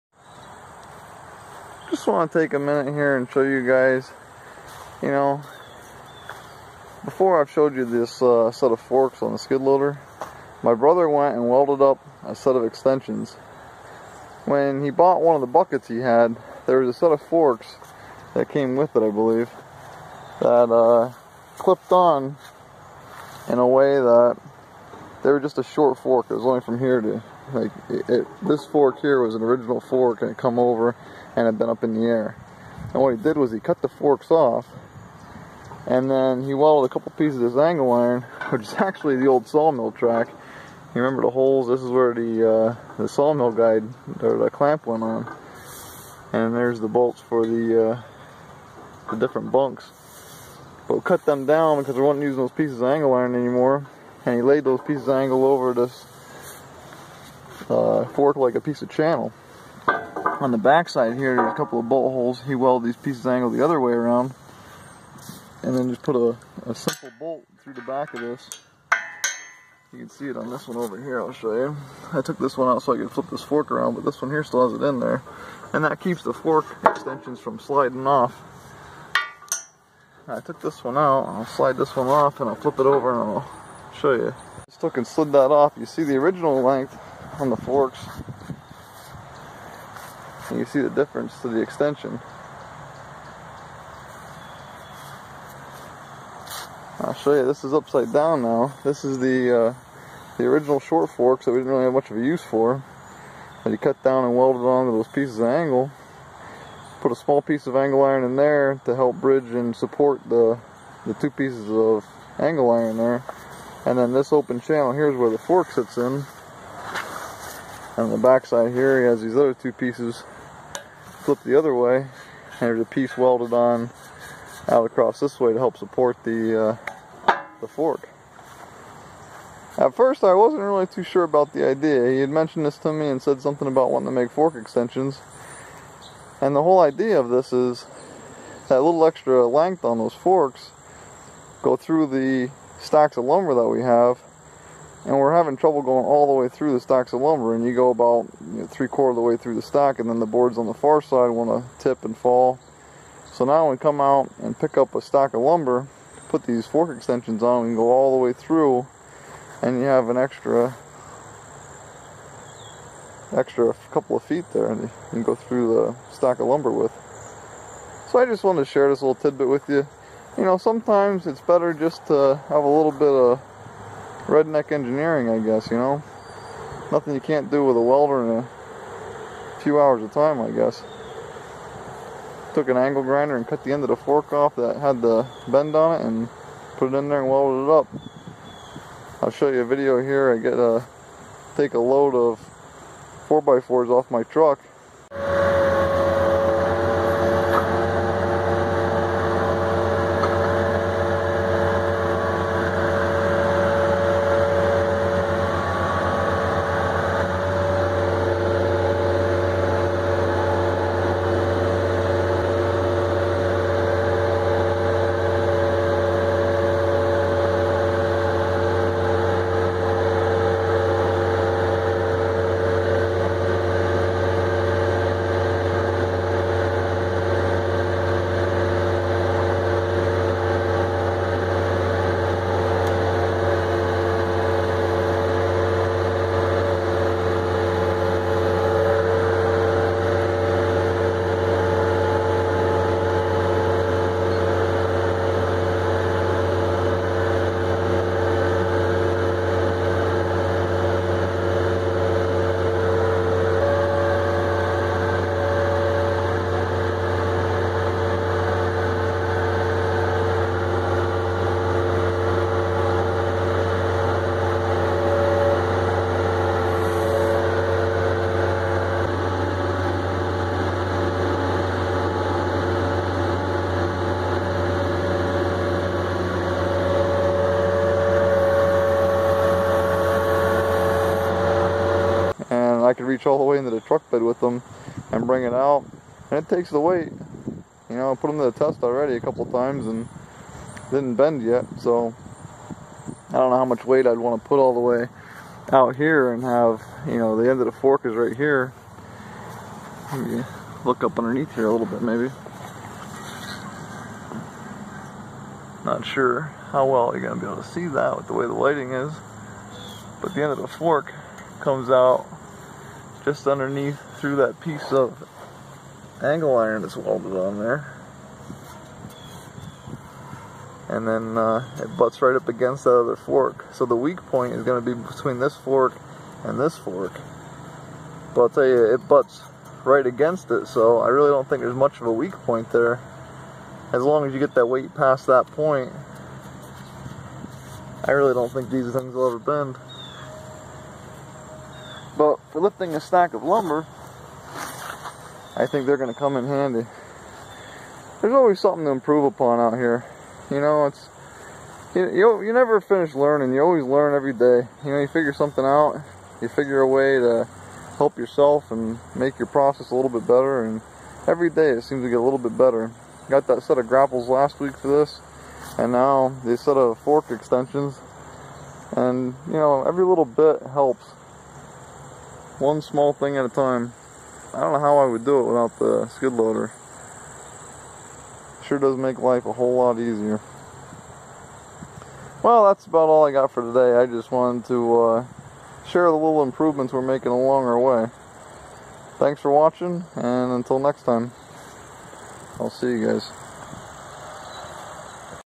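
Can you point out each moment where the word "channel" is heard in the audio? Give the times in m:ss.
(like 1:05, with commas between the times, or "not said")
0:58, 1:54.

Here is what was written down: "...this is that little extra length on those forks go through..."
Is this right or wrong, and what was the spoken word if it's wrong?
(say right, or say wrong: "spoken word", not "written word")
right.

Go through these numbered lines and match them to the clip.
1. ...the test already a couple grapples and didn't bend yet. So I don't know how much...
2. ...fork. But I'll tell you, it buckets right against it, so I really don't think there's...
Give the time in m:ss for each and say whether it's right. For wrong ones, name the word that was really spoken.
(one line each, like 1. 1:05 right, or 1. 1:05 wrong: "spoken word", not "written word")
1. 4:48 wrong: "times", not "grapples"
2. 5:26 wrong: "butts", not "buckets".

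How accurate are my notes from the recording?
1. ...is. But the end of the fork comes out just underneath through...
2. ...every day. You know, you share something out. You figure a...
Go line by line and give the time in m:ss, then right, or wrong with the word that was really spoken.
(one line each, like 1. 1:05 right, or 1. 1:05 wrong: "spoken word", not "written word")
1. 5:08 right
2. 5:54 wrong: "figure", not "share".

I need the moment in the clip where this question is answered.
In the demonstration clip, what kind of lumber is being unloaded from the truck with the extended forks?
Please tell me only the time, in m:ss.
3:13.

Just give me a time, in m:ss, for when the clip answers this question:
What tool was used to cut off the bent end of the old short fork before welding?
3:02.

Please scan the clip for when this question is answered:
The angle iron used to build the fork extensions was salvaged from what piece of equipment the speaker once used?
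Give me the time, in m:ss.
0:39.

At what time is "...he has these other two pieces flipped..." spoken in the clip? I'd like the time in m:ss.
1:58.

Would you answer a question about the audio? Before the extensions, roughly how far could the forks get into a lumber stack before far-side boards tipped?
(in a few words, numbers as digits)
three quarter.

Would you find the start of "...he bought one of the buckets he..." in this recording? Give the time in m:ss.
0:14.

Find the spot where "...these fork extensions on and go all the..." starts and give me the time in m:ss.
2:36.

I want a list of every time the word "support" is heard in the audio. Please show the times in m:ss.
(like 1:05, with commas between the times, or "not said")
1:49, 2:05.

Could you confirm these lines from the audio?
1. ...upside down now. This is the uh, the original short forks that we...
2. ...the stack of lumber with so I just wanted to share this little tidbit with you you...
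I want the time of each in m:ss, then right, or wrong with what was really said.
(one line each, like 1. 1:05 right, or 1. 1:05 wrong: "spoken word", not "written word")
1. 1:37 right
2. 2:45 right.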